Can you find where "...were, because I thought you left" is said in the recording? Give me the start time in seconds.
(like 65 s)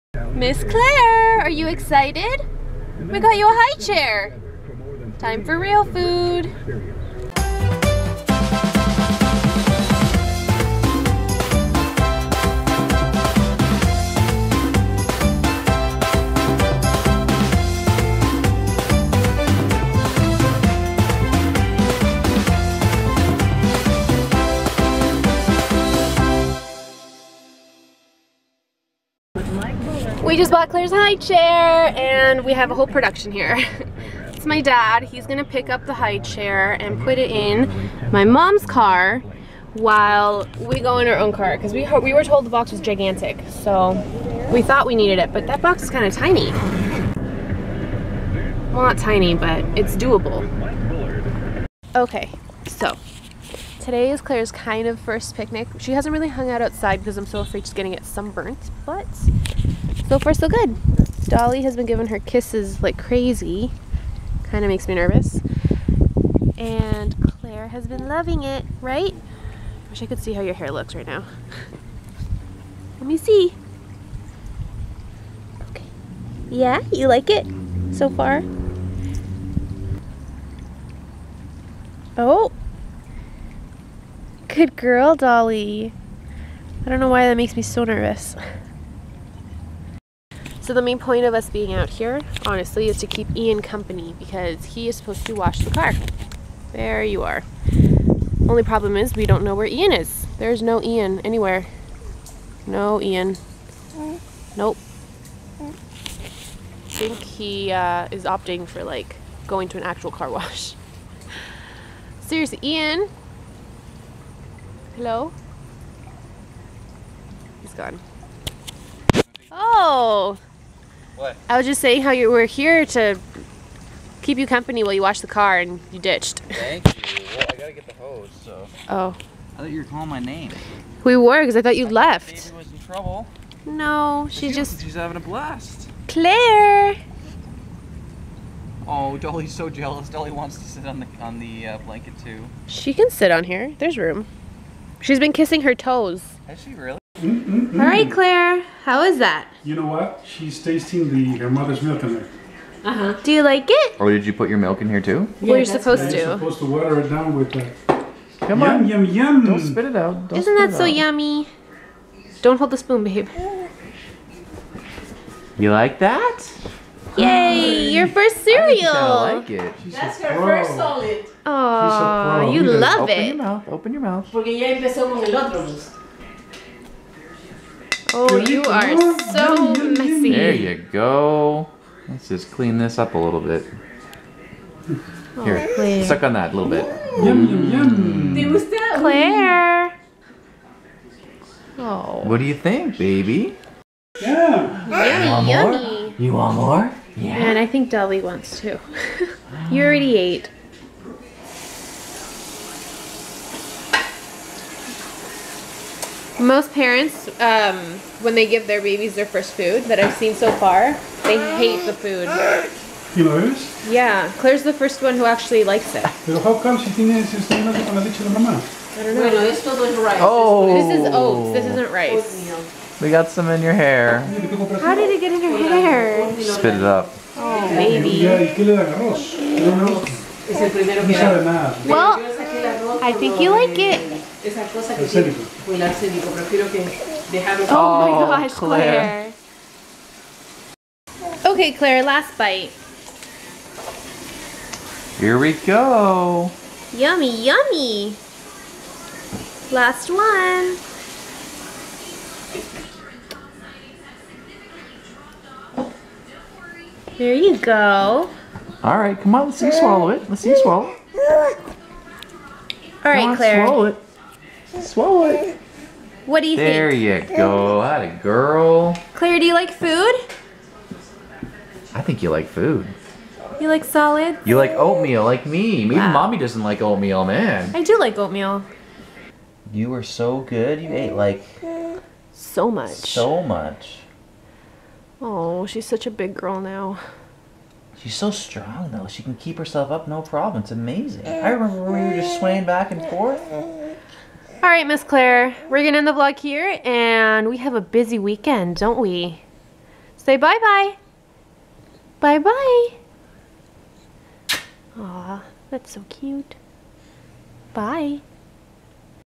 131 s.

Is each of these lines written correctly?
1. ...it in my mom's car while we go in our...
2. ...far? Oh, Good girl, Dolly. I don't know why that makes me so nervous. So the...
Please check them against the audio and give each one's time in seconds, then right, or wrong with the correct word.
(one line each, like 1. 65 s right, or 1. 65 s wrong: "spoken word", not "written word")
1. 37 s right
2. 78 s right.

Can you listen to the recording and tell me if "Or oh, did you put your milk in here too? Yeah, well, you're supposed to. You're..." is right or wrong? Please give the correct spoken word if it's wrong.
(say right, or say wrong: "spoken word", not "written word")
right.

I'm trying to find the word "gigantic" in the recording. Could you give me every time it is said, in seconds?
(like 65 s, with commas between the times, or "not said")
42 s.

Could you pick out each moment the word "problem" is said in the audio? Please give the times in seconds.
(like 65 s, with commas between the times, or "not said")
98 s, 290 s.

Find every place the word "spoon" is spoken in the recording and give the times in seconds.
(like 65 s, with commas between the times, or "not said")
162 s.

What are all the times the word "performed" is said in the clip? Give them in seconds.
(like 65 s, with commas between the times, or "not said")
not said.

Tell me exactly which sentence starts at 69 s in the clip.
Wish I could see how your hair looks right now.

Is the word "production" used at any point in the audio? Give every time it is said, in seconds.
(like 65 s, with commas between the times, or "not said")
32 s.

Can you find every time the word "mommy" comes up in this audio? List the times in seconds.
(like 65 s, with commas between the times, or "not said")
276 s.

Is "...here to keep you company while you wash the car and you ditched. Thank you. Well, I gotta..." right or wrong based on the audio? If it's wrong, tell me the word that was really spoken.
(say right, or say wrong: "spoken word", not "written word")
right.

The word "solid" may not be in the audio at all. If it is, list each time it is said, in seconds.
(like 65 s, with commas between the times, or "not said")
170 s, 273 s.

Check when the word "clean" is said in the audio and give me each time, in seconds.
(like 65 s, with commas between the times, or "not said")
182 s.